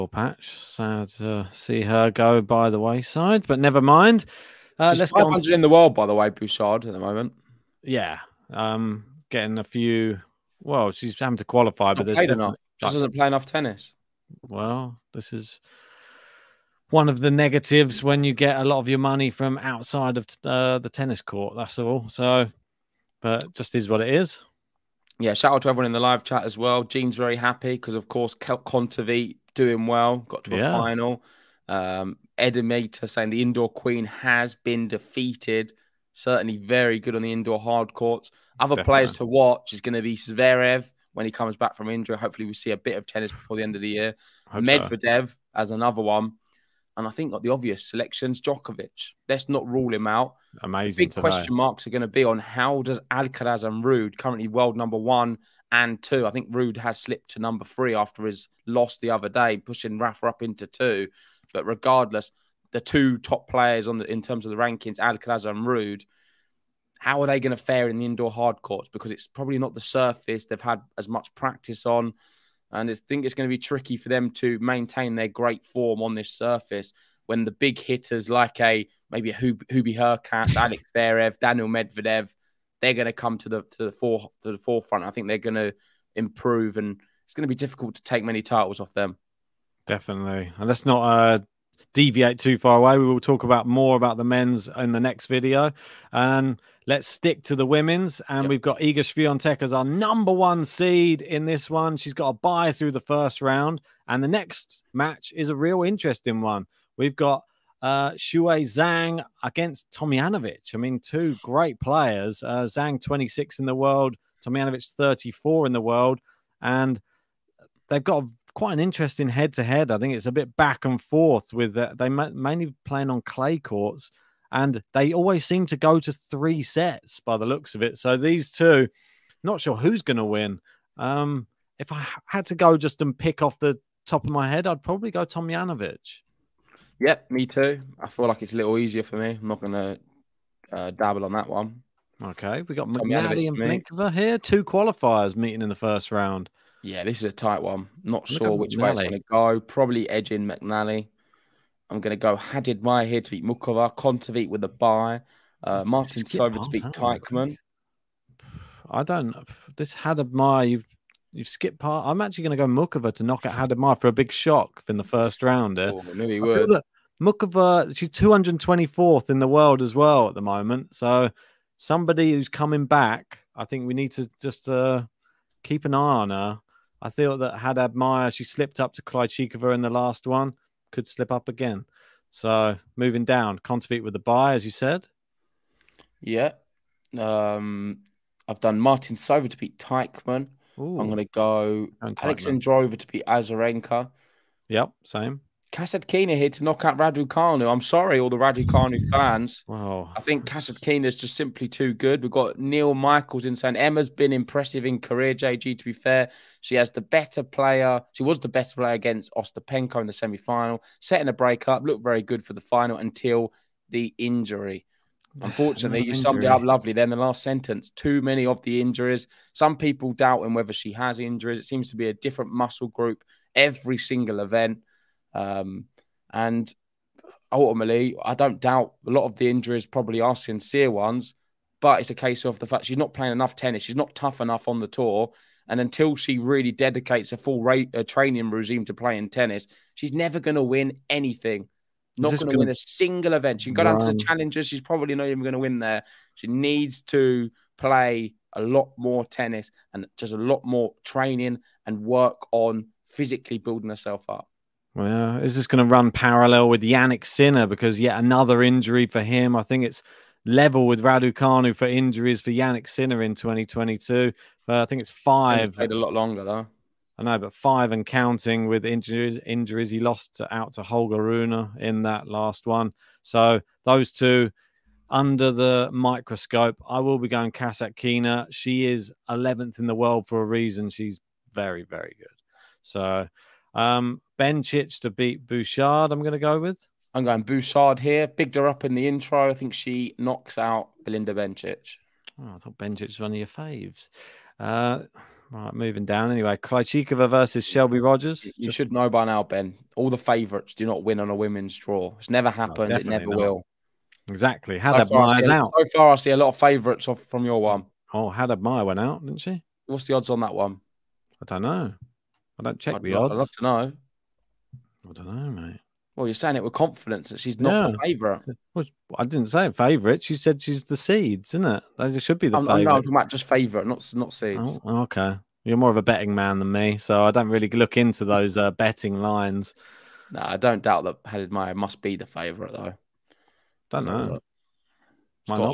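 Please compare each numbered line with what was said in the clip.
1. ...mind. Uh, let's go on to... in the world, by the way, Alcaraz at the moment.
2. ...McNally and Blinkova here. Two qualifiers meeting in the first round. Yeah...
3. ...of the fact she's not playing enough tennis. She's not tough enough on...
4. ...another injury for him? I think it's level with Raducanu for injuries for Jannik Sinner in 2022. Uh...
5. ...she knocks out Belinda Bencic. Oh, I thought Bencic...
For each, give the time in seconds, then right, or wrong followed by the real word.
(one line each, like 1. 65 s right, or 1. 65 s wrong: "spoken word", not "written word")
1. 3 s wrong: "Bouchard", not "Alcaraz"
2. 142 s right
3. 232 s right
4. 258 s right
5. 289 s right.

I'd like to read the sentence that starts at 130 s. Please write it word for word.
Um, if I had to go just and pick off the top of my head, I'd probably go Tomljanovic.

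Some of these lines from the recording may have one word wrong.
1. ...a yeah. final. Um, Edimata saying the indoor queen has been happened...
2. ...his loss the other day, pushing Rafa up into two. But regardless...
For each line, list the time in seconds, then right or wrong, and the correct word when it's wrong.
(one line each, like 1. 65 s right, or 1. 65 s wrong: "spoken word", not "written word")
1. 30 s wrong: "defeated", not "happened"
2. 58 s right.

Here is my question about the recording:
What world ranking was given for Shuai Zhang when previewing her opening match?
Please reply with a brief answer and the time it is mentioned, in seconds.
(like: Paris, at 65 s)
26, at 113 s.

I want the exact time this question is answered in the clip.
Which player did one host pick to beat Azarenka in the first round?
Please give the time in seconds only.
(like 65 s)
192 s.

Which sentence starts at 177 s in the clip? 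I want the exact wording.
I thought that Haddad Maia, she slipped up to Krejcikova in the last one, could slip up again.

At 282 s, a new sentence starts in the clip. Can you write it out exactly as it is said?
So um, Bencic to beat Bouchard, I'm going to go with.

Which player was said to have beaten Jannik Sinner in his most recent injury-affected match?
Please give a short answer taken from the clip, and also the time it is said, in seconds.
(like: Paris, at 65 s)
Holger Rune, at 270 s.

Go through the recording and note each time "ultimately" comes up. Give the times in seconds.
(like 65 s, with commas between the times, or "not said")
227 s.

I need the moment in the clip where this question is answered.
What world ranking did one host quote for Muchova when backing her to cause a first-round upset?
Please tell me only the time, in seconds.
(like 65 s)
168 s.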